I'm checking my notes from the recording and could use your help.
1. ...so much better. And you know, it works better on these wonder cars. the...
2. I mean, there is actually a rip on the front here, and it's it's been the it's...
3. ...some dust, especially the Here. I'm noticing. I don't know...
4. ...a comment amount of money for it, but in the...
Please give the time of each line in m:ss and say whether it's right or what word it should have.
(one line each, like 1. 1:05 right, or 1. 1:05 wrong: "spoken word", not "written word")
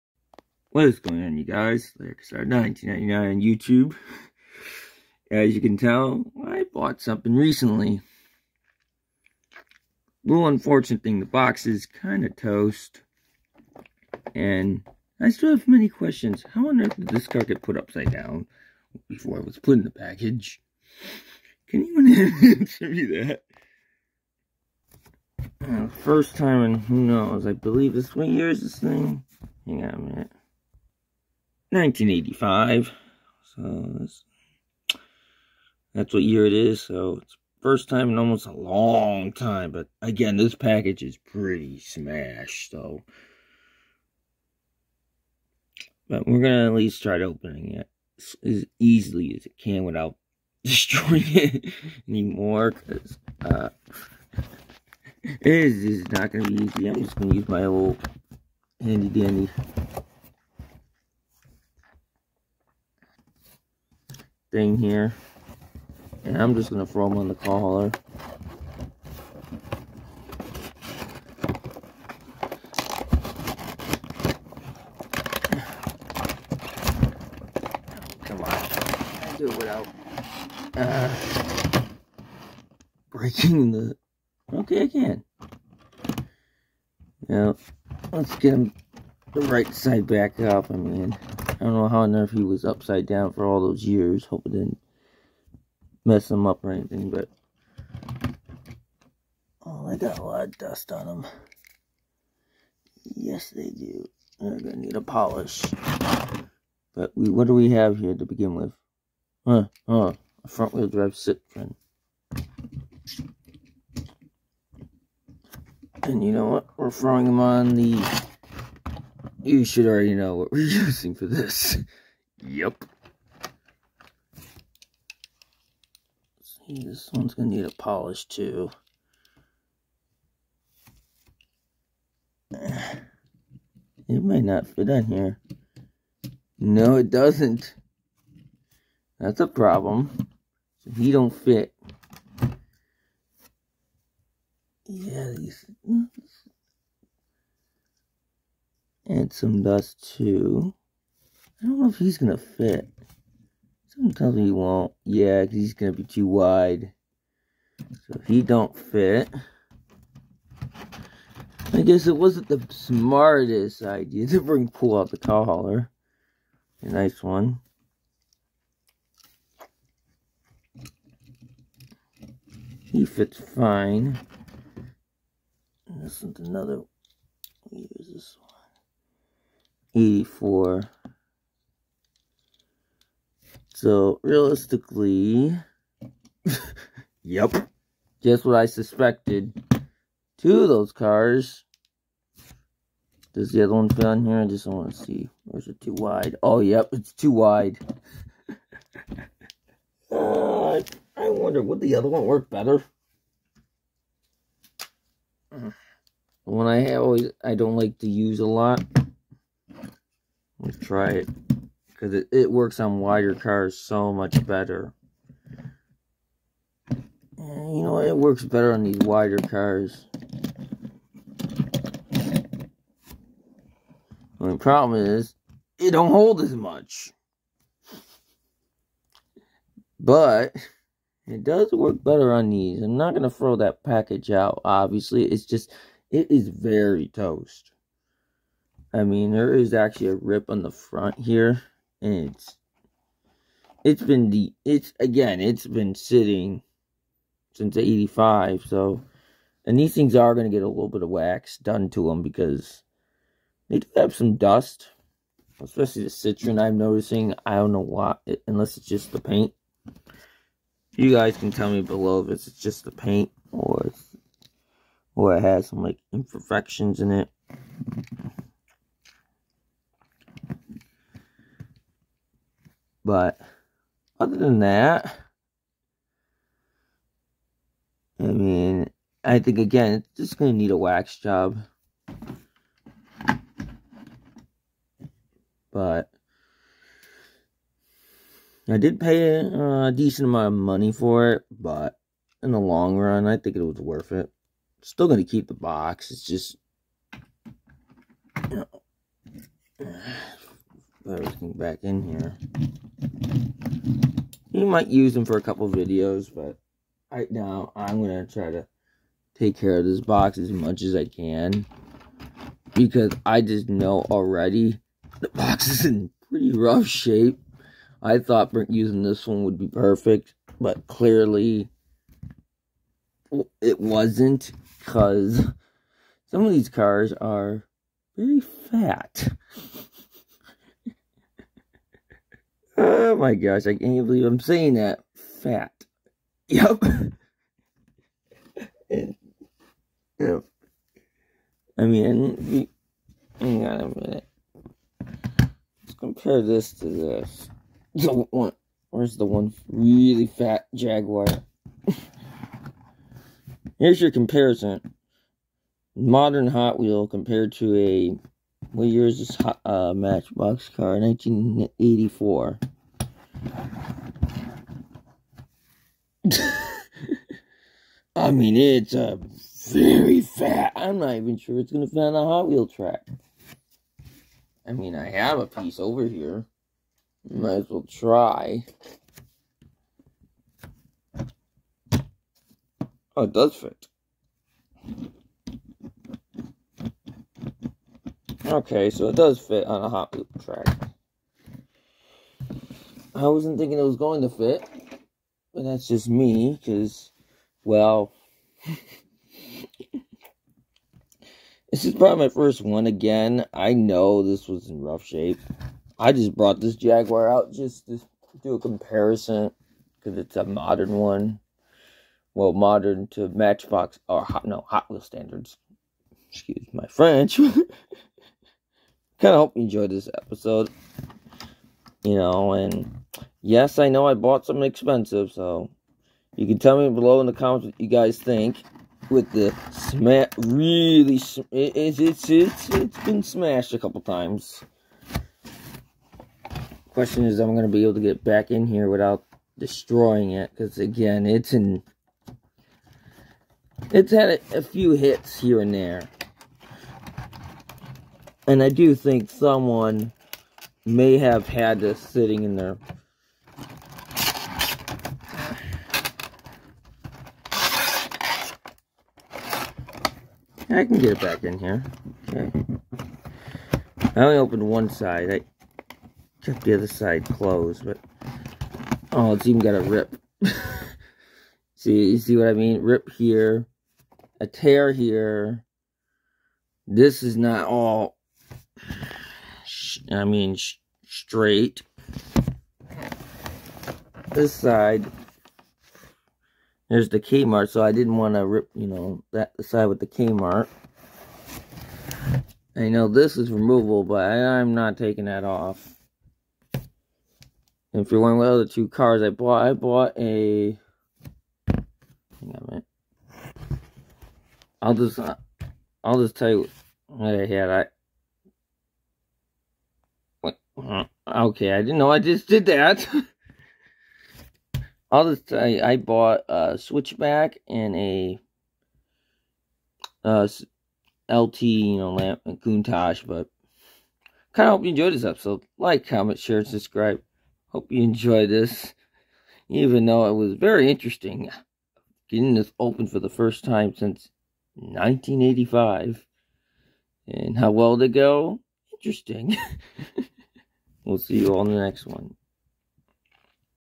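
1. 3:33 wrong: "wider", not "wonder"
2. 3:58 right
3. 4:14 wrong: "Citroen", not "Here"
4. 4:49 wrong: "decent", not "comment".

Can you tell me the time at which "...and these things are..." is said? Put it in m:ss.
4:09.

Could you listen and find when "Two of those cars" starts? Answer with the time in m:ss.
3:10.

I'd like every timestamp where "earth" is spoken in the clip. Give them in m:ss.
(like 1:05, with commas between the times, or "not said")
0:16, 1:32.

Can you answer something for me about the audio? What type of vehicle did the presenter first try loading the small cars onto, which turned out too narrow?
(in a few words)
cow hauler.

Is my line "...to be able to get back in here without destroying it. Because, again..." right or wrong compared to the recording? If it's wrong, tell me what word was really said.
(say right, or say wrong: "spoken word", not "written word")
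right.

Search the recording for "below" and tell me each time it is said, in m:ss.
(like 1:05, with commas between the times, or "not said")
4:21, 7:06.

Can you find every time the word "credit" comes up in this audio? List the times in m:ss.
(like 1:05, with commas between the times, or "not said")
not said.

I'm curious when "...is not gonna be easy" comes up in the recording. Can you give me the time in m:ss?
0:55.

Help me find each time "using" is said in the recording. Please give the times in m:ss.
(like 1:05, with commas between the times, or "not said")
2:00, 5:18.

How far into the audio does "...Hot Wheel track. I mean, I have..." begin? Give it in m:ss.
6:12.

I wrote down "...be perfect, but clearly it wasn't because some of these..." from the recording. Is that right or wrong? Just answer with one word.
right.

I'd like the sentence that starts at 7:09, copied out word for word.
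With the smash, really, sm it's, it's, it's, it's been smashed a couple times.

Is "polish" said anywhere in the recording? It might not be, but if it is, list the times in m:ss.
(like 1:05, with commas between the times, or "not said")
1:45, 2:07.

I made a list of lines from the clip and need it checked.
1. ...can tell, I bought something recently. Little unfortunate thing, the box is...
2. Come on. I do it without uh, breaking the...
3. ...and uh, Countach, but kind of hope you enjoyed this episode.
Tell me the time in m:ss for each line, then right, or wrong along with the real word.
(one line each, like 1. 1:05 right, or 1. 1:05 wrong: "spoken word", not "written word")
1. 0:05 right
2. 1:18 right
3. 8:42 right.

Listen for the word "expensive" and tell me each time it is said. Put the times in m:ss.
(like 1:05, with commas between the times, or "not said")
7:04.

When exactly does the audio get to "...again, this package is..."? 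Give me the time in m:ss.
0:40.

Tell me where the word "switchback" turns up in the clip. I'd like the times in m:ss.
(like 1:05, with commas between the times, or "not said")
8:36.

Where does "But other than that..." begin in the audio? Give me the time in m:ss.
4:33.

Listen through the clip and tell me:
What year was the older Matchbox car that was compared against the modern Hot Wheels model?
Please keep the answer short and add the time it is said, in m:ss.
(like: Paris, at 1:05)
1984, at 6:00.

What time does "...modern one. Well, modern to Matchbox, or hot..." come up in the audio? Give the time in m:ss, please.
6:50.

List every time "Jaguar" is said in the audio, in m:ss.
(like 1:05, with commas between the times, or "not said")
5:50, 6:46.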